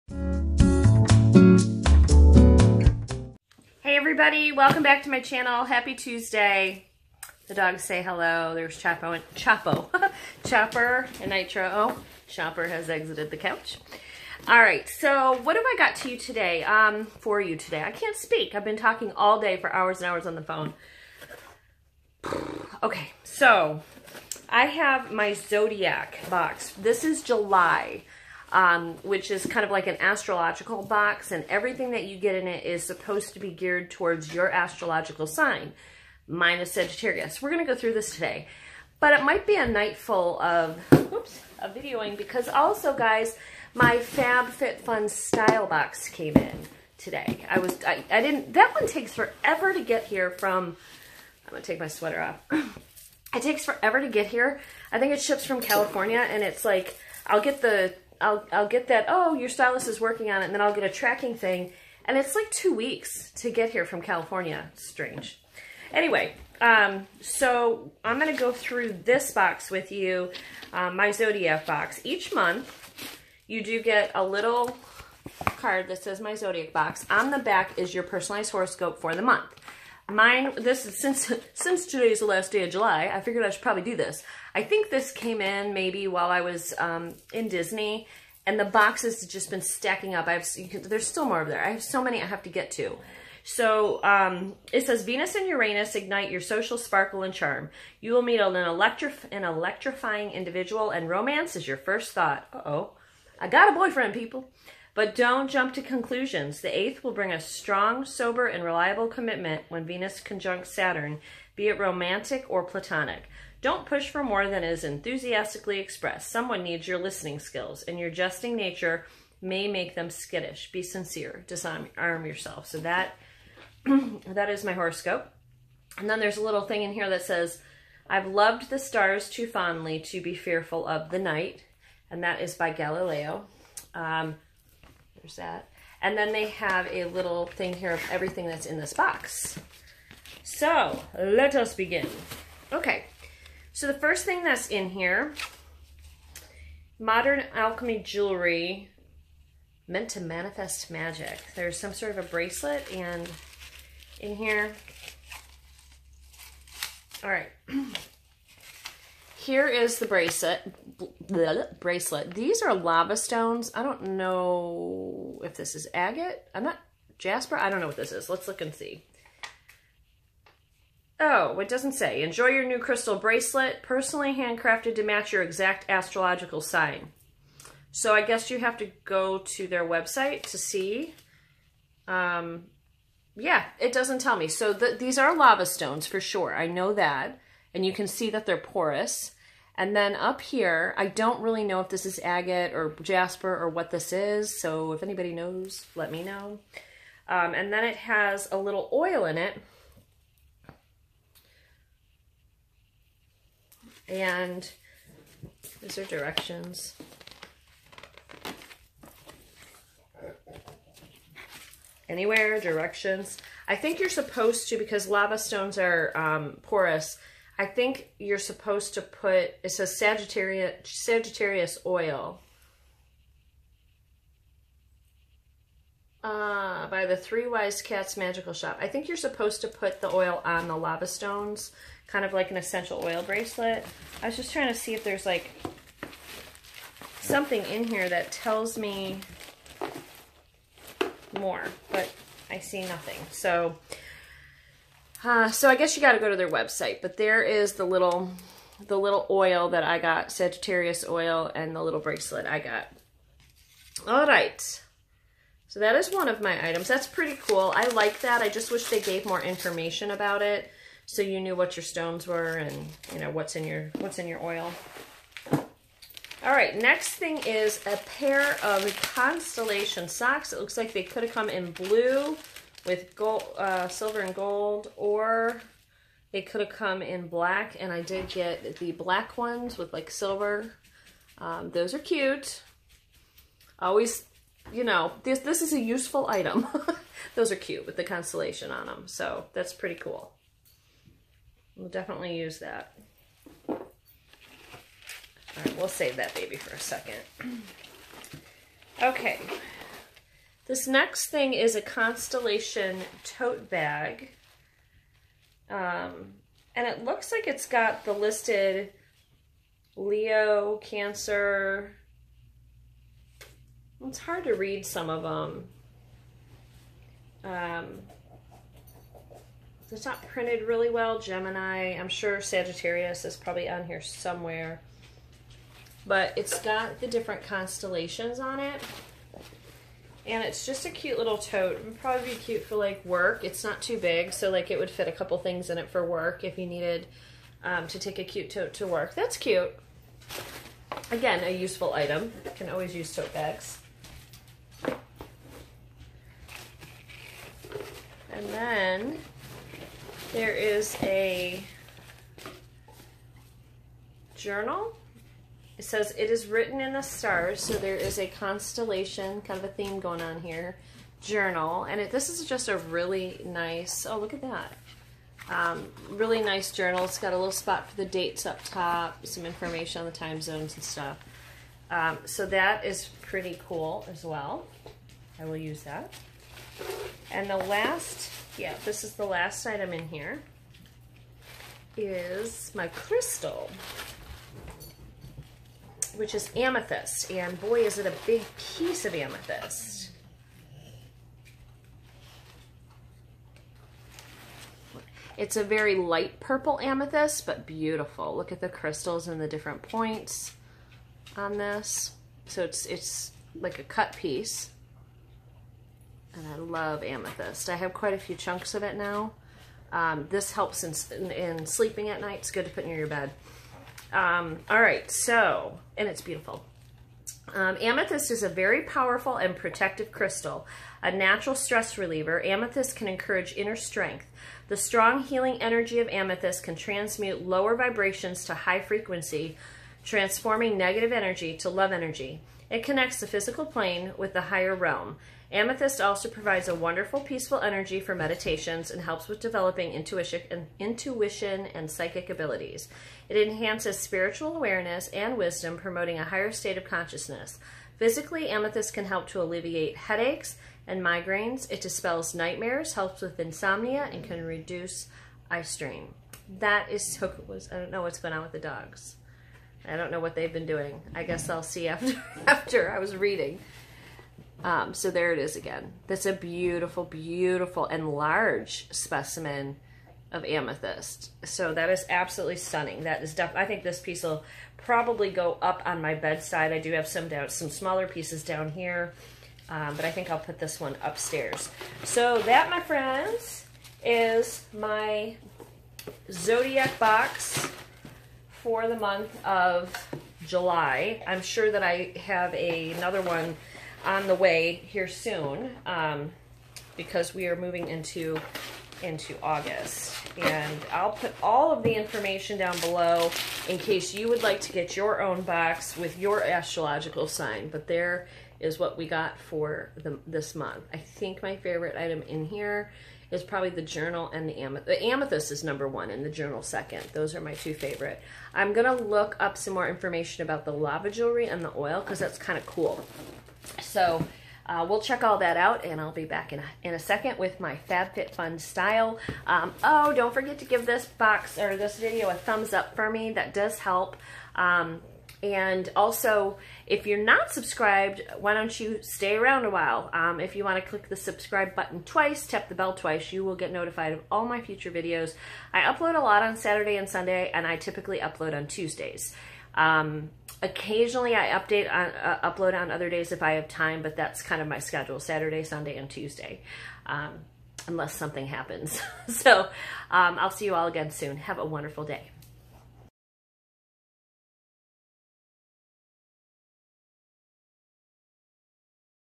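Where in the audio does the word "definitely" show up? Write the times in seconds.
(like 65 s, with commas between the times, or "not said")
291 s, 473 s.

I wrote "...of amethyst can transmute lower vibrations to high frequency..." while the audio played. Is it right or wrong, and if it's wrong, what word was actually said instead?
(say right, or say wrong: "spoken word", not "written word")
right.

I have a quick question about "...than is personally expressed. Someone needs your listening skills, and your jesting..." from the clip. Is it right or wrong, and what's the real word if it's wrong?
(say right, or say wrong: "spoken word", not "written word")
wrong: "enthusiastically", not "personally".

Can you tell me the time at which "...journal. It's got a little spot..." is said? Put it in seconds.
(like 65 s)
366 s.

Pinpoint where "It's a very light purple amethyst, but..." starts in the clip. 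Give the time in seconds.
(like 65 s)
395 s.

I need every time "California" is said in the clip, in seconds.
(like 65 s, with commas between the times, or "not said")
55 s, 64 s.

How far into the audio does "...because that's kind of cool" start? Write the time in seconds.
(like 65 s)
522 s.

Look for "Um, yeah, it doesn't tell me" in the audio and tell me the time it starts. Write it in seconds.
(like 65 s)
182 s.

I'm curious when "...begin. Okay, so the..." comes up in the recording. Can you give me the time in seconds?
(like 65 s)
141 s.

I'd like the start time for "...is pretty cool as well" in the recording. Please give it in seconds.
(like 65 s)
372 s.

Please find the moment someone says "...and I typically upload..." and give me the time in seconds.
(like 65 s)
547 s.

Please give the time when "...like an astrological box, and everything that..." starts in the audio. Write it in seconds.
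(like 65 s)
29 s.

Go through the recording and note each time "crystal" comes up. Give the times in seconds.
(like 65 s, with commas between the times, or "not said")
172 s, 382 s, 398 s, 420 s.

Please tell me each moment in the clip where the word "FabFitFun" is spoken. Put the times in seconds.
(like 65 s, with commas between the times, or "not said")
43 s, 527 s.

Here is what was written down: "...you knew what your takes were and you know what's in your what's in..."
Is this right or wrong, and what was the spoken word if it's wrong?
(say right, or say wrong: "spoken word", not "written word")
wrong: "stones", not "takes".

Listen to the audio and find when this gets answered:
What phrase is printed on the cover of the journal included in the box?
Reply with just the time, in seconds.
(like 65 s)
356 s.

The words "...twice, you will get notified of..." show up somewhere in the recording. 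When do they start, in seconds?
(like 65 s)
542 s.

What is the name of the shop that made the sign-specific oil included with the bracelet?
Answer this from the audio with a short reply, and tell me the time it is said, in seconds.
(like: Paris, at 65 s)
Three Wise Cats Magical Shop, at 227 s.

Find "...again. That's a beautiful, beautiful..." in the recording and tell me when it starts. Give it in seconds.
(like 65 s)
465 s.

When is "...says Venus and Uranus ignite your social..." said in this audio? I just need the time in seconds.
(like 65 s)
94 s.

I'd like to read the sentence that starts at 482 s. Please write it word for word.
So that, my friends, is my Zodiac box for the month of July.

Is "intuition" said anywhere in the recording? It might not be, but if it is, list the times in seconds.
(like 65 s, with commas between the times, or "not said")
439 s.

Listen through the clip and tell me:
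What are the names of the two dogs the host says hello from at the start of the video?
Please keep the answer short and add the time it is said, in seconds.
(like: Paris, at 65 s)
Chopper and Nitro, at 10 s.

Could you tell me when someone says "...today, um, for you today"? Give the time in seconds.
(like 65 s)
16 s.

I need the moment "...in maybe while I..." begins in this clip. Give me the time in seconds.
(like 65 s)
85 s.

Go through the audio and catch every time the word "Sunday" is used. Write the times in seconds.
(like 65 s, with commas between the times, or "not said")
547 s, 555 s.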